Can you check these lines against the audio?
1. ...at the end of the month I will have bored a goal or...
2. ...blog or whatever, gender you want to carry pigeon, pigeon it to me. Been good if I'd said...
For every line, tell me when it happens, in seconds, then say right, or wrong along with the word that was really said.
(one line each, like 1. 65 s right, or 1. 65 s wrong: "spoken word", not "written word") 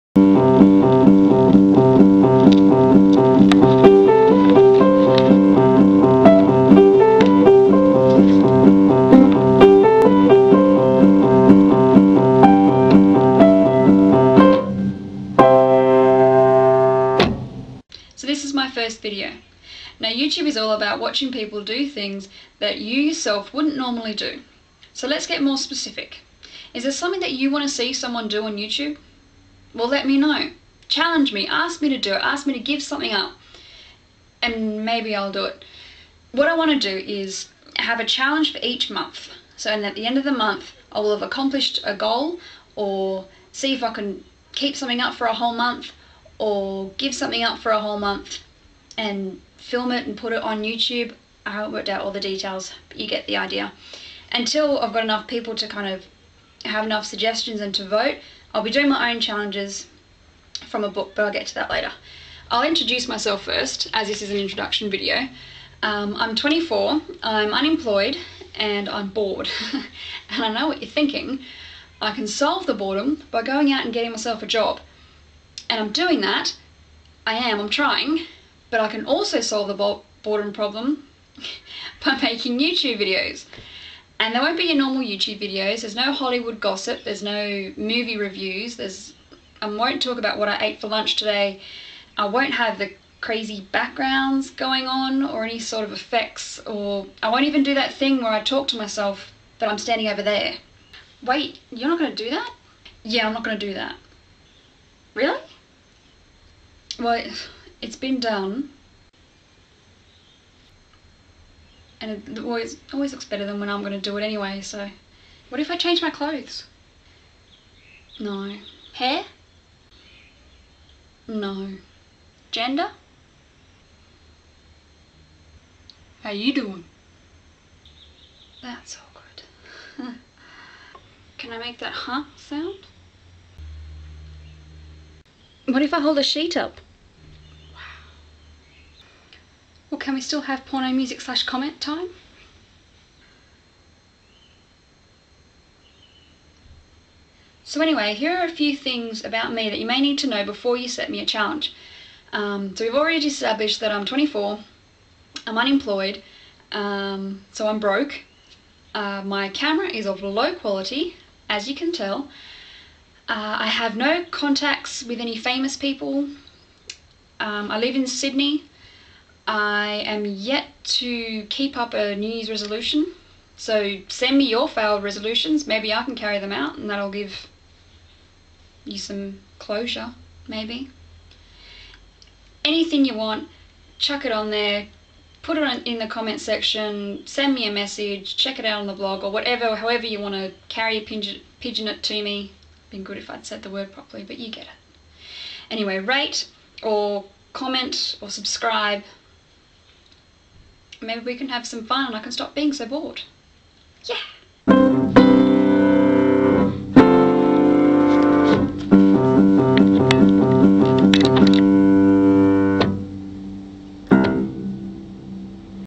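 1. 39 s wrong: "accomplished", not "bored"
2. 188 s wrong: "however", not "gender".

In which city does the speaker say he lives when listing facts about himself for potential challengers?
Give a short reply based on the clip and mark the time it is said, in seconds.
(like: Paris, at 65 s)
Sydney, at 168 s.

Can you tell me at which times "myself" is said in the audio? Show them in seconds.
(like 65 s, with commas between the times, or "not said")
63 s, 74 s, 98 s.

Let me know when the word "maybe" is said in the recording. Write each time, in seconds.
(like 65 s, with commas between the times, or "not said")
34 s, 175 s, 180 s, 201 s.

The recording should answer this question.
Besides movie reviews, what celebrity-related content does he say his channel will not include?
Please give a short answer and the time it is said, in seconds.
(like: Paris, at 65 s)
Hollywood gossip, at 86 s.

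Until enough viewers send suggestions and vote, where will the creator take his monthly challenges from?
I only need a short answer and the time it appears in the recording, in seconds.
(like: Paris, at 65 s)
A book, at 60 s.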